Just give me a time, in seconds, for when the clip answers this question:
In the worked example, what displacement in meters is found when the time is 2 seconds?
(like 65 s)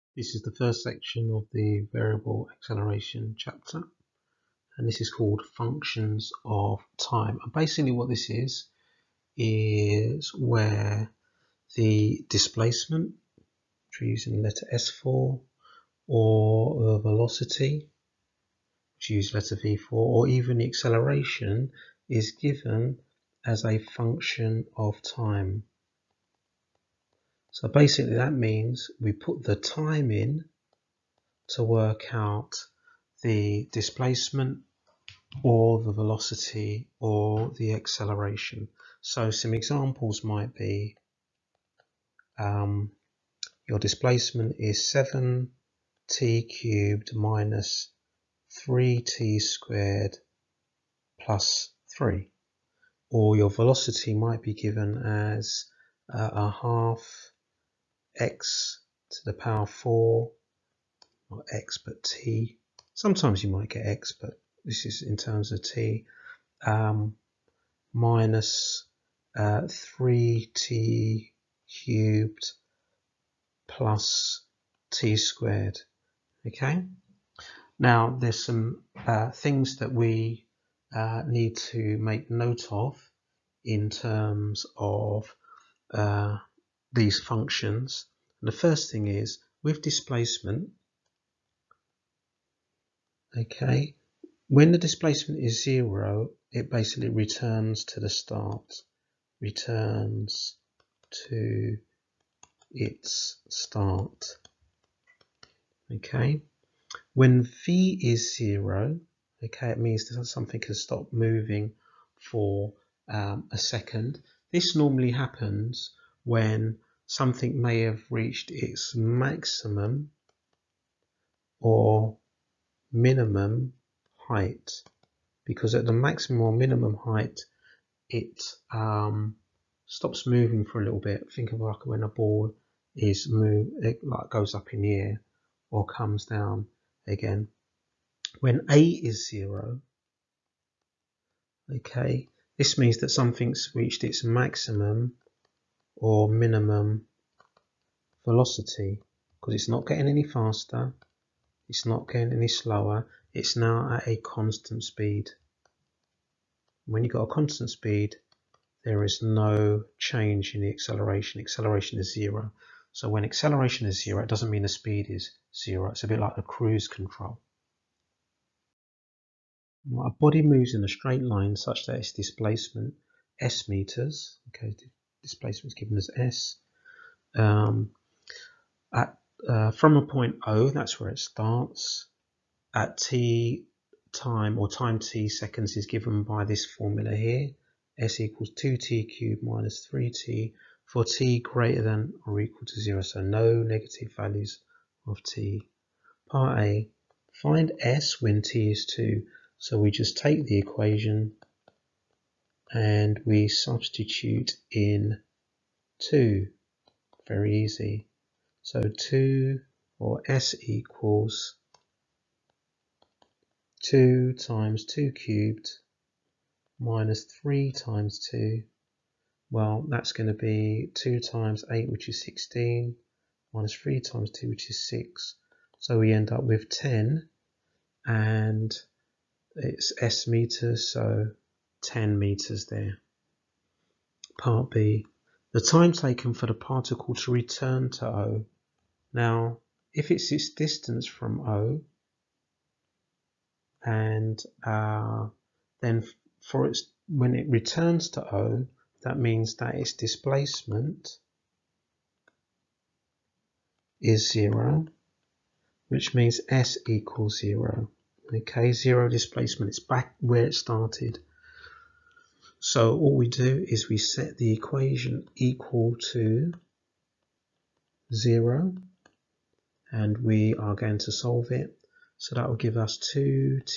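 231 s.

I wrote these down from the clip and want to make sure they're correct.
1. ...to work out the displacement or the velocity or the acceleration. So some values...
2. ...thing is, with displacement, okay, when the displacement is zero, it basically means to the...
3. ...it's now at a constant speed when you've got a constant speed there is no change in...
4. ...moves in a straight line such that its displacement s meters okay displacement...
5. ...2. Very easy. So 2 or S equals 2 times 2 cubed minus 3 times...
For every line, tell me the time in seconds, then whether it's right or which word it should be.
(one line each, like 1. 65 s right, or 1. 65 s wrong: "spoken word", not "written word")
1. 31 s wrong: "examples", not "values"
2. 88 s wrong: "returns", not "means"
3. 153 s right
4. 170 s right
5. 206 s right.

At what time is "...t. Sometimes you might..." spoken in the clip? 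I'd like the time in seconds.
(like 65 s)
62 s.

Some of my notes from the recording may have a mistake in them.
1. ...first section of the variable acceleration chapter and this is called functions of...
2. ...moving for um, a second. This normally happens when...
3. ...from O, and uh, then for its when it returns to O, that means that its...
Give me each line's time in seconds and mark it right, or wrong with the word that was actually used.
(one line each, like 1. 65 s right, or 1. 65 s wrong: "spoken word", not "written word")
1. 0 s right
2. 111 s right
3. 241 s right.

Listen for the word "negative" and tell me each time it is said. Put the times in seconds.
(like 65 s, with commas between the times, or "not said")
193 s.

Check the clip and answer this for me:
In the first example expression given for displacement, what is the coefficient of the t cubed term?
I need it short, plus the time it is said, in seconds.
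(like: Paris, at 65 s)
7, at 44 s.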